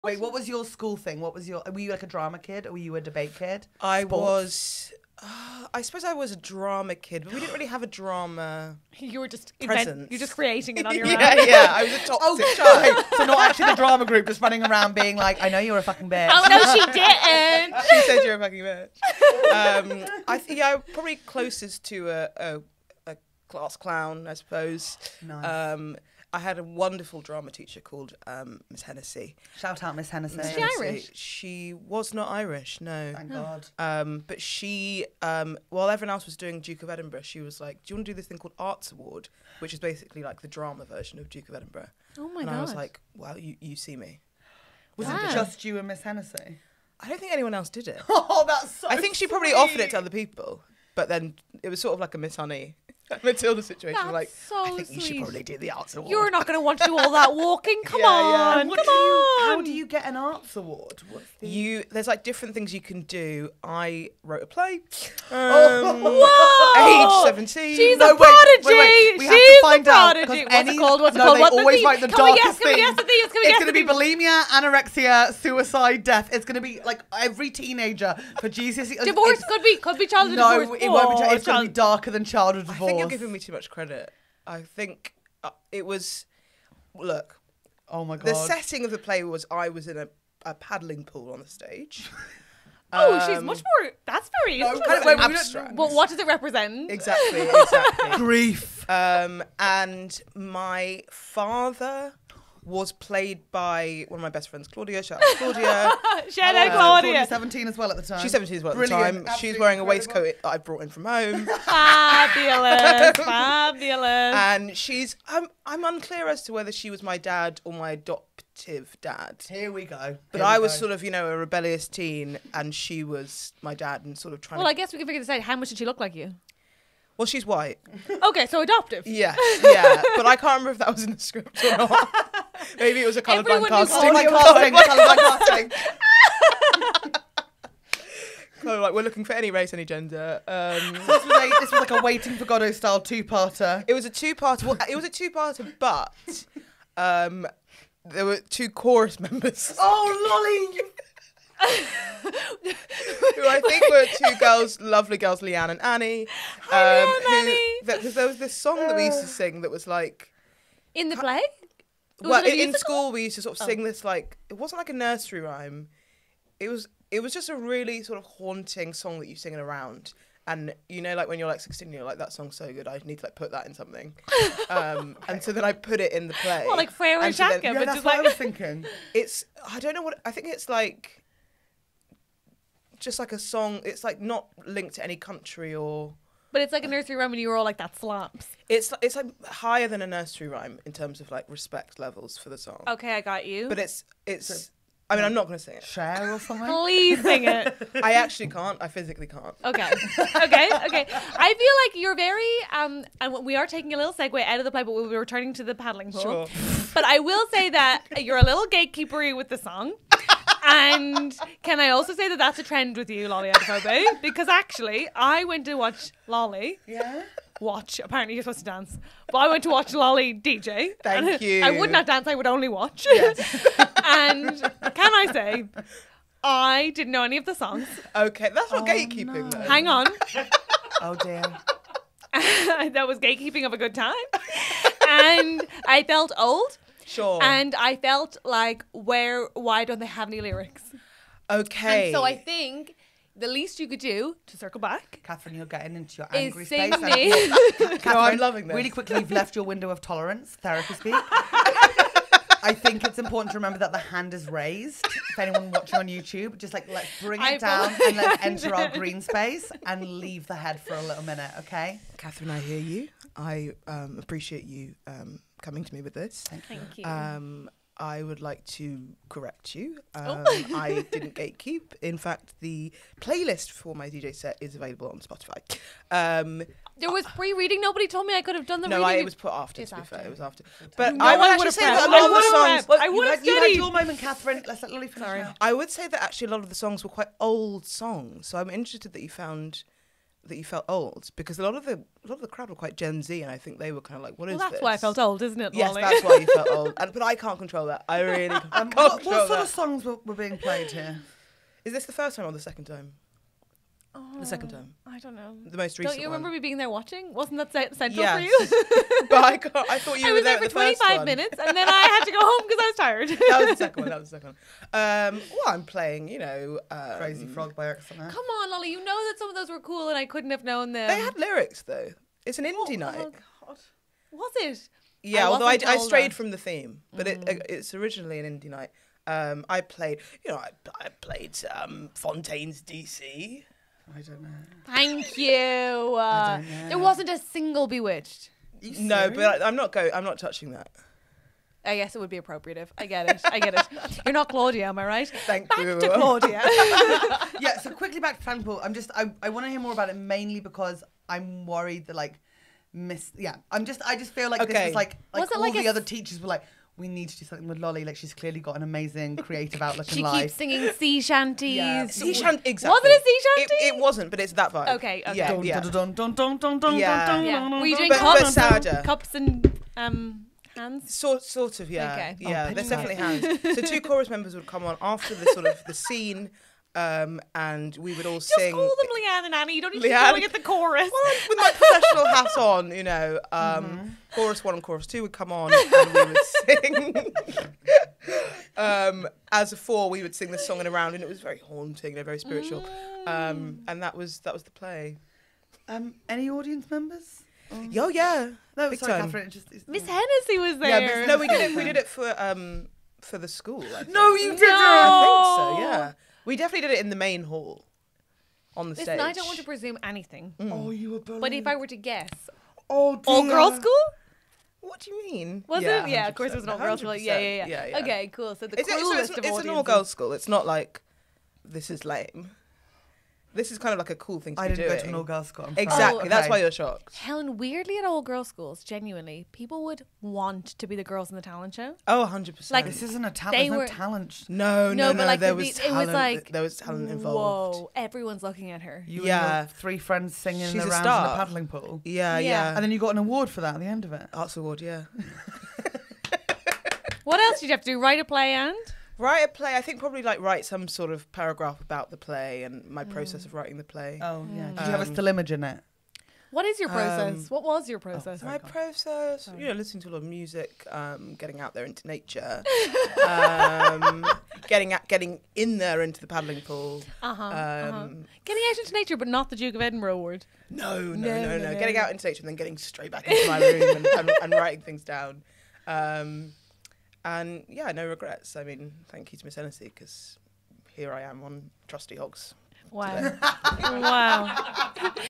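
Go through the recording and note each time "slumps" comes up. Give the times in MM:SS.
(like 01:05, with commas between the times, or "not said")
03:07.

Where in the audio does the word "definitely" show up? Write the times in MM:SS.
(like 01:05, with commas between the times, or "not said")
06:12, 06:46.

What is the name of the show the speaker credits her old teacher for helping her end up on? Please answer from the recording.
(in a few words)
Trusty Hogs.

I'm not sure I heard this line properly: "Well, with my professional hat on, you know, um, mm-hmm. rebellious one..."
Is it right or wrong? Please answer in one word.
wrong.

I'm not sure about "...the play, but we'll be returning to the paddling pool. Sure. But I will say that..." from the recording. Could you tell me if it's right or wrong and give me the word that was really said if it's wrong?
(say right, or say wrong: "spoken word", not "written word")
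right.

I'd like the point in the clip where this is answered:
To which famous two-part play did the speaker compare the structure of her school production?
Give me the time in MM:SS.
02:22.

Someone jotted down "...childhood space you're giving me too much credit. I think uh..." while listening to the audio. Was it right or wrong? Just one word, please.
wrong.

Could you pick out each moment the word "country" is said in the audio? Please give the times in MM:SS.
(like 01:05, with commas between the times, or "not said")
03:05.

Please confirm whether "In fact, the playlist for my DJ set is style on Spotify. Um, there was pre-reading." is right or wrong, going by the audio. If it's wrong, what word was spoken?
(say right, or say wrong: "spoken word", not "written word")
wrong: "available", not "style".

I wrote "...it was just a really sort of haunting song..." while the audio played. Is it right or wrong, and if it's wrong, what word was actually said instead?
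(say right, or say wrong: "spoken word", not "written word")
right.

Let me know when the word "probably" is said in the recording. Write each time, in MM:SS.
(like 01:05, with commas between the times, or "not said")
00:20, 00:49, 00:55, 07:29.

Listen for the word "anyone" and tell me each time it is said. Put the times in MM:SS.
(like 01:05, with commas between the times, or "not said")
00:47, 04:15.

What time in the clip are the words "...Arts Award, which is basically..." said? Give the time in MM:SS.
00:38.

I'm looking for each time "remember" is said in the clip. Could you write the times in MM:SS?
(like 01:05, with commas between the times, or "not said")
02:10, 04:13, 05:06.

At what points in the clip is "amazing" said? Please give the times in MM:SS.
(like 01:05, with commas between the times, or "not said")
05:58.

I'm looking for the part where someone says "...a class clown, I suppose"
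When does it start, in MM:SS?
00:23.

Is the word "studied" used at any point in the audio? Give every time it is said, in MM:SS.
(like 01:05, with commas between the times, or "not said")
04:43.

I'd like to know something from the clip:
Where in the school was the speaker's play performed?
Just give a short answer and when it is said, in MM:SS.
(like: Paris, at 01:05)
the main hall, at 06:47.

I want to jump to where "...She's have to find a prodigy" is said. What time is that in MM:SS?
01:09.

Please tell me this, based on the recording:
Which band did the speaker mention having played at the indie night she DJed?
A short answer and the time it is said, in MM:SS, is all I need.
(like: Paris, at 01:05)
Fontaines DC, at 05:32.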